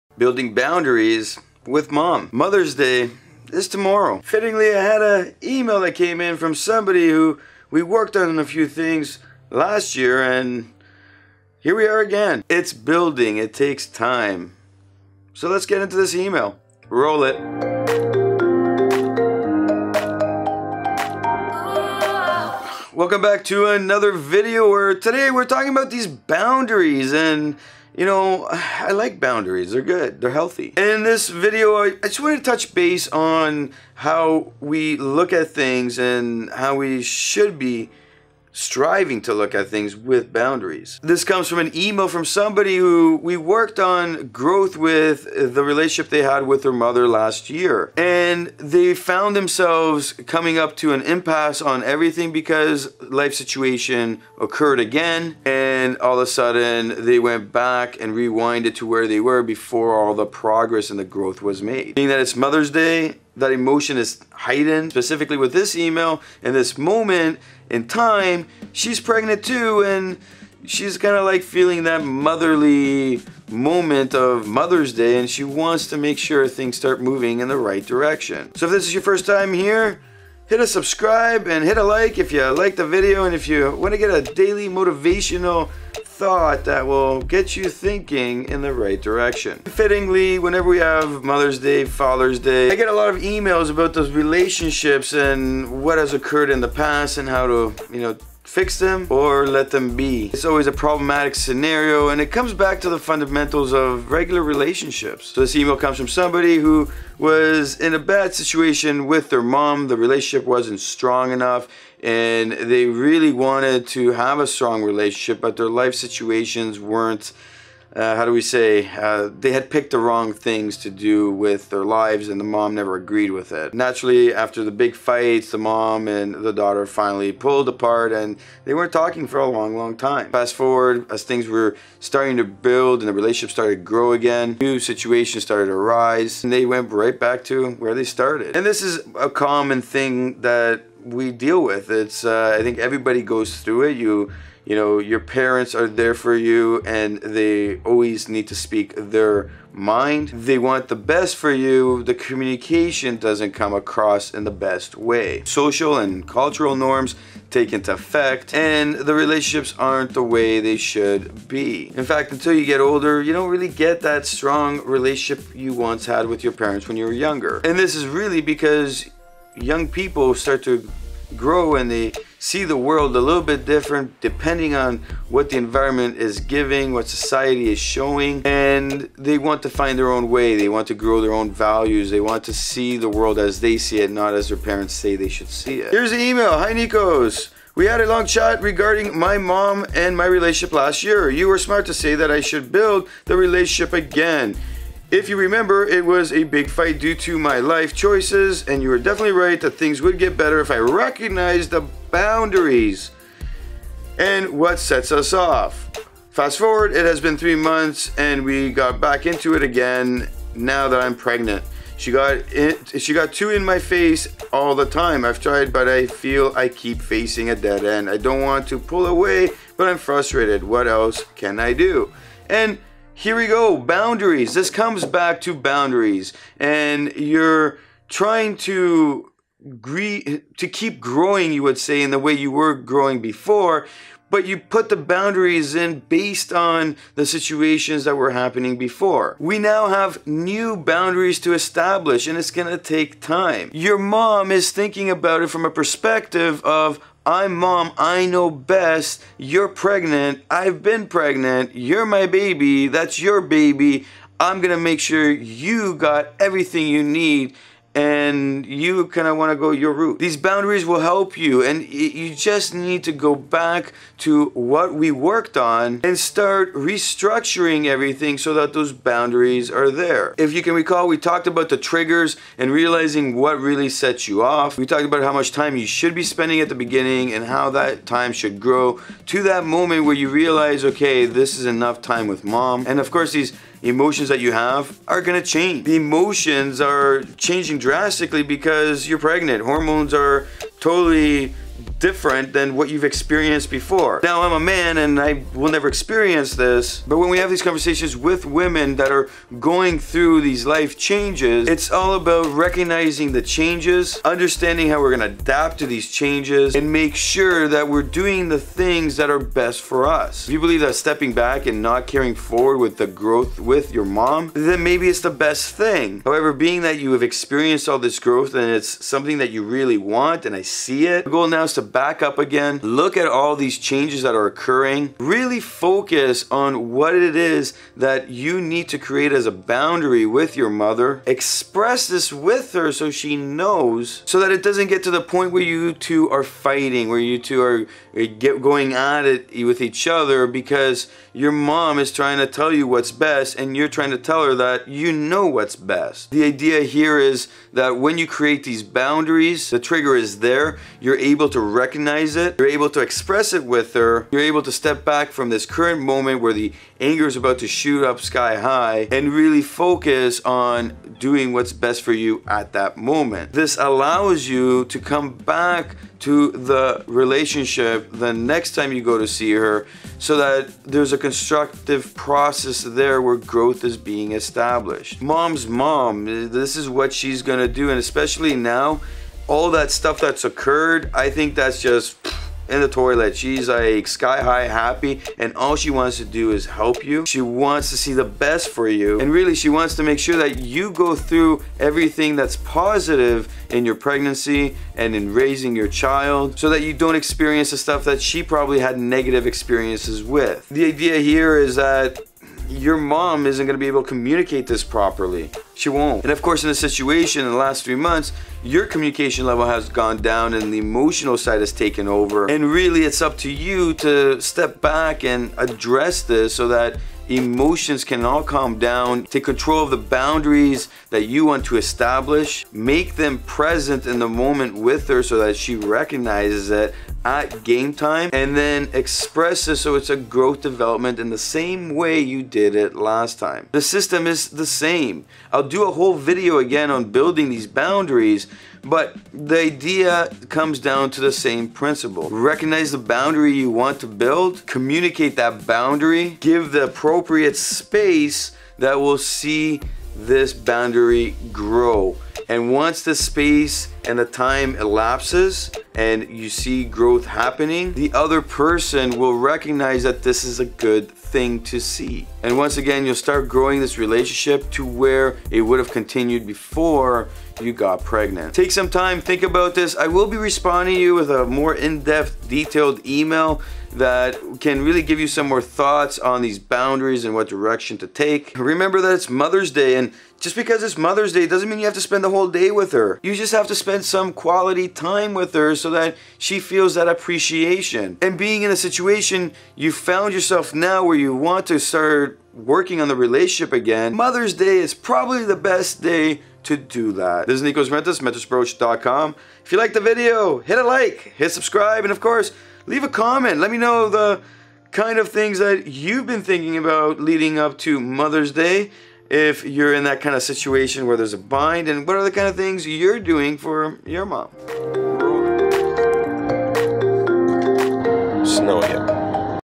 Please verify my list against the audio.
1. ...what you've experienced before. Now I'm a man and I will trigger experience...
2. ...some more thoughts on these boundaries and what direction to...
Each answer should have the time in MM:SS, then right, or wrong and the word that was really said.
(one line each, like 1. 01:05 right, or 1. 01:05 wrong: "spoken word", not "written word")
1. 04:52 wrong: "never", not "trigger"
2. 07:55 right.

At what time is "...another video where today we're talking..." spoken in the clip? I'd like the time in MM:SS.
00:23.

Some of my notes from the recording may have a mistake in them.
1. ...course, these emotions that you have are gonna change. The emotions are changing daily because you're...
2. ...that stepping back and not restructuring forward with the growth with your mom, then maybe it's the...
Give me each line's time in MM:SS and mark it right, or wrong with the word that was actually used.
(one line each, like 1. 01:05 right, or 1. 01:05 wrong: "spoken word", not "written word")
1. 04:43 wrong: "drastically", not "daily"
2. 05:10 wrong: "carrying", not "restructuring".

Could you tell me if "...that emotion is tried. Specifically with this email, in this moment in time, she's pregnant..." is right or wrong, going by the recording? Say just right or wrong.
wrong.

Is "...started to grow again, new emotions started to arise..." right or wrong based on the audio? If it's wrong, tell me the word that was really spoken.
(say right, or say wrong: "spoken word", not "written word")
wrong: "situations", not "emotions".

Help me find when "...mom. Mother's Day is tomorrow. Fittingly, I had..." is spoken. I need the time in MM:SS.
00:01.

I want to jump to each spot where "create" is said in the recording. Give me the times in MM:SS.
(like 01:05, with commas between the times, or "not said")
05:28, 05:48.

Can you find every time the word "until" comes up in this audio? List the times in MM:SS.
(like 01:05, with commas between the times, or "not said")
02:42.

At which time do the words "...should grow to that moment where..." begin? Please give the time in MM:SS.
04:38.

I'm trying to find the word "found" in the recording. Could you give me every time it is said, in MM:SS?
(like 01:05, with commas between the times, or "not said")
00:48, 08:09.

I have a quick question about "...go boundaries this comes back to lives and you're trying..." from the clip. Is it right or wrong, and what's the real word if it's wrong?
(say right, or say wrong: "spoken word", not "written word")
wrong: "boundaries", not "lives".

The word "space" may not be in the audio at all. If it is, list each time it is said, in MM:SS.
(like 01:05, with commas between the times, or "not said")
07:27, 07:33.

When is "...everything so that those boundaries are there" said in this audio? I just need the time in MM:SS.
04:27.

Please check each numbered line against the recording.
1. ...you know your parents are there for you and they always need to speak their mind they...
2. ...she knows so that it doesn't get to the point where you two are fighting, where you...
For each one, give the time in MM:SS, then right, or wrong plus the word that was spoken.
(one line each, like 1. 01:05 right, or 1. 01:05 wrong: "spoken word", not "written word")
1. 02:24 right
2. 05:33 right.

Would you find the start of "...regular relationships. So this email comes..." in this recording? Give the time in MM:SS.
01:44.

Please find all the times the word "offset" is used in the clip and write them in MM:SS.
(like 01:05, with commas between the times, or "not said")
not said.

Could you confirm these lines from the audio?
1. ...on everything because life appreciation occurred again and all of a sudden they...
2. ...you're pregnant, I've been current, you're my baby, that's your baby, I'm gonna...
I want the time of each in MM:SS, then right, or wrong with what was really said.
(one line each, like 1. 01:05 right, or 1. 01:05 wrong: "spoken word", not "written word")
1. 00:51 wrong: "situation", not "appreciation"
2. 04:09 wrong: "pregnant", not "current".